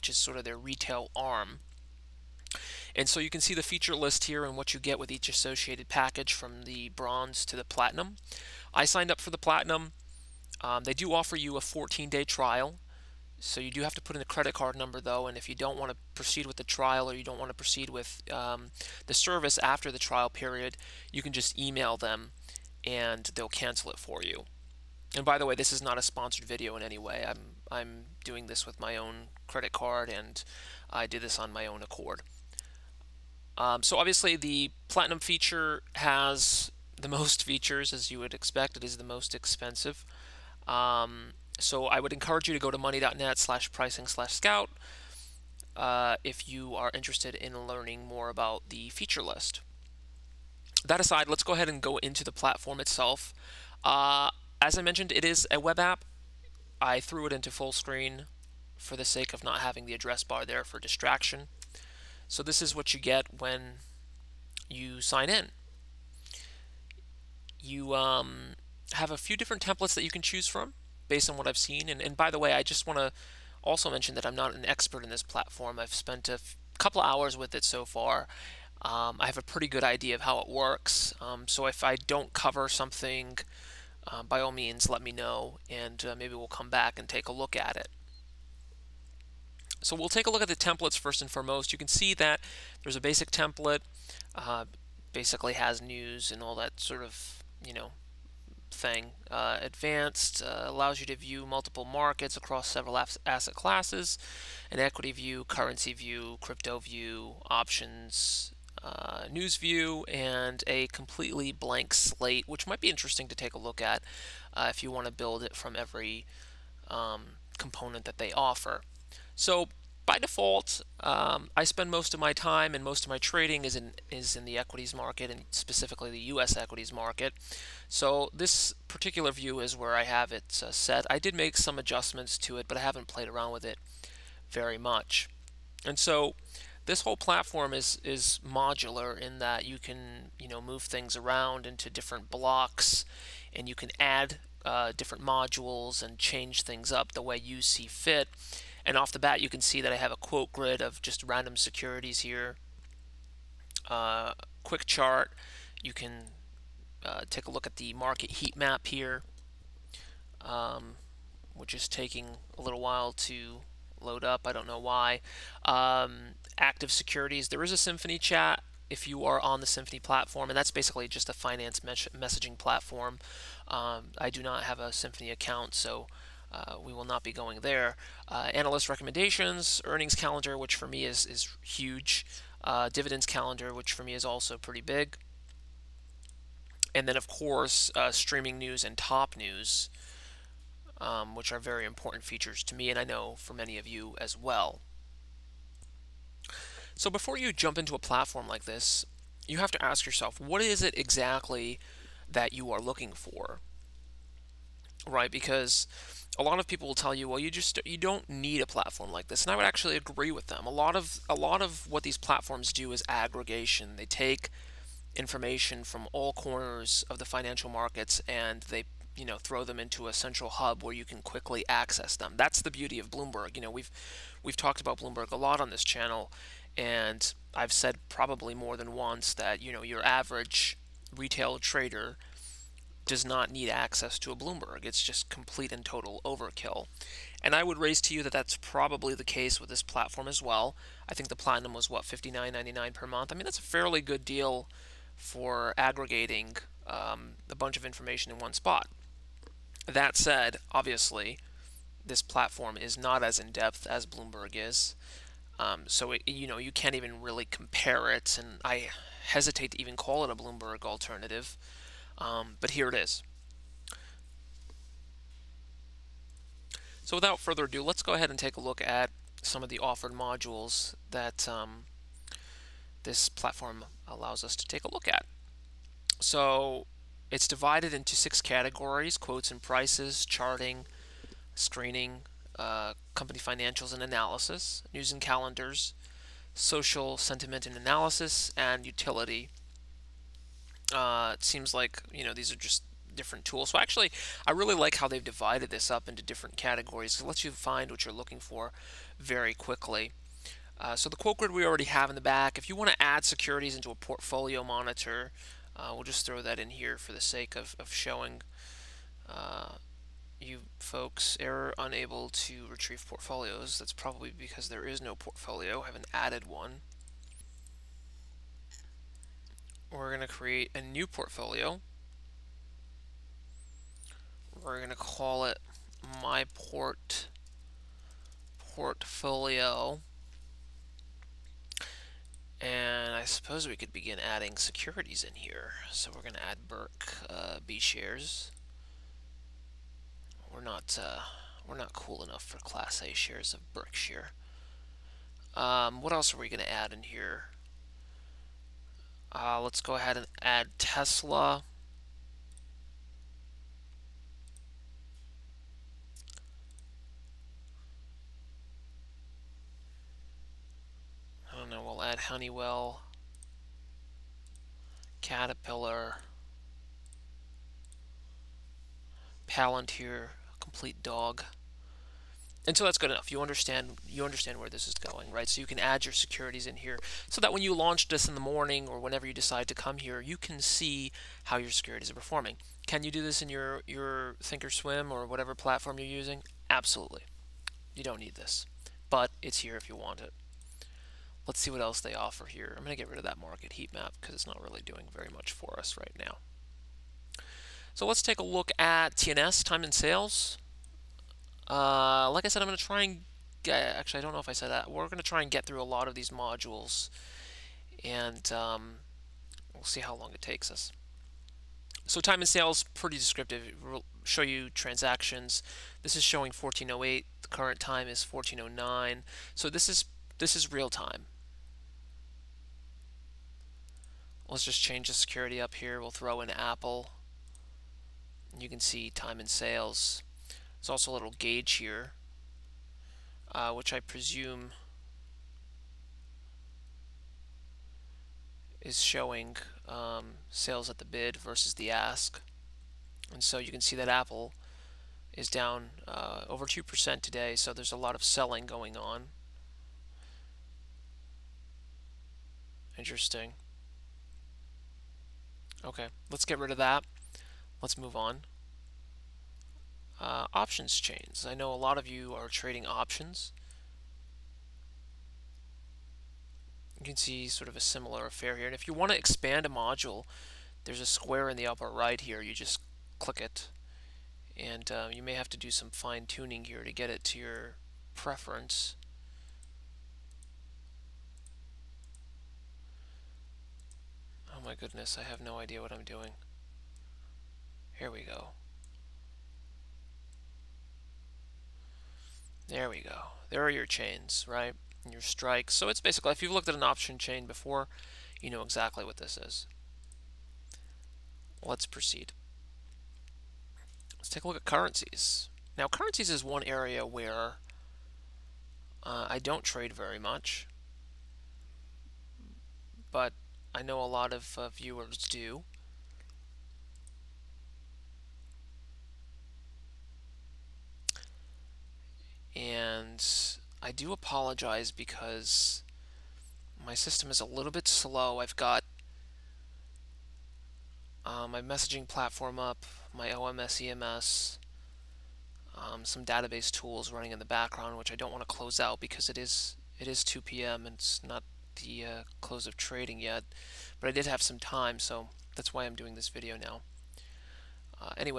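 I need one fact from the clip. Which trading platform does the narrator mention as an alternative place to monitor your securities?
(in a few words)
thinkorswim.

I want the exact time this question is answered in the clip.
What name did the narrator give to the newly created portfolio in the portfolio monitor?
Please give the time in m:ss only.
5:26.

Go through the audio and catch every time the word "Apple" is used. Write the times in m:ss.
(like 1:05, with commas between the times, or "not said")
7:06, 7:24.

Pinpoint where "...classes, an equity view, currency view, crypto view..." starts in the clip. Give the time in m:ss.
1:43.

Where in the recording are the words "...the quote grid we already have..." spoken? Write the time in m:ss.
5:01.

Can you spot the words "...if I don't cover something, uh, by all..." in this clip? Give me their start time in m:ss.
1:21.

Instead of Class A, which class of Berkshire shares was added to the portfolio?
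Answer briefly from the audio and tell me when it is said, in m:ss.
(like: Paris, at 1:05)
B shares, at 5:37.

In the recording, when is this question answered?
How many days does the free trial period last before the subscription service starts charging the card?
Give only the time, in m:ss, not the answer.
0:11.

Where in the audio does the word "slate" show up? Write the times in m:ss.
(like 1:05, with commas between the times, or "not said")
1:51.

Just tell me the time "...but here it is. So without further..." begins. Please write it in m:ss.
4:22.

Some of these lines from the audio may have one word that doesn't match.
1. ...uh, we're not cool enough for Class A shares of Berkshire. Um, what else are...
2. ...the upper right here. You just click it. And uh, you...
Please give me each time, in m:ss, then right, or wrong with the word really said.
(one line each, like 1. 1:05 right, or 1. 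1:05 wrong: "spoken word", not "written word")
1. 5:41 right
2. 7:51 right.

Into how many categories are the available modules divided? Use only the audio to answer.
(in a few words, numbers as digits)
6.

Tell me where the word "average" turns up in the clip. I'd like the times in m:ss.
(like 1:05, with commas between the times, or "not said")
3:50.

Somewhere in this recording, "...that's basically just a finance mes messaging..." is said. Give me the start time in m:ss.
2:50.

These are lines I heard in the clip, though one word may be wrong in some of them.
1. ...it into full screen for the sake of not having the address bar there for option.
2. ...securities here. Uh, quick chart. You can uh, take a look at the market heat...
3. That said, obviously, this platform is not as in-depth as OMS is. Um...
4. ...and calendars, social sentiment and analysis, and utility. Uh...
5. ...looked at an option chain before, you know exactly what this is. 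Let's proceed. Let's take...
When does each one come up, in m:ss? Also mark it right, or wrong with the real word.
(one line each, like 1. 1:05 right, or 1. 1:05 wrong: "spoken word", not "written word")
1. 0:57 wrong: "distraction", not "option"
2. 2:31 right
3. 4:09 wrong: "Bloomberg", not "OMS"
4. 4:45 right
5. 8:16 right.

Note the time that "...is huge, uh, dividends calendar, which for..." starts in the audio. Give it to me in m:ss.
3:01.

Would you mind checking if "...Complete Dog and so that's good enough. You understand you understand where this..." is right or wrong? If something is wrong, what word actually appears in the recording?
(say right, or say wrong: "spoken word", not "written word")
right.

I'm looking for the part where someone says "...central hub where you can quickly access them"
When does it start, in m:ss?
3:40.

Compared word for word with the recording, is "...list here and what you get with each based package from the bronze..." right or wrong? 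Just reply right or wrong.
wrong.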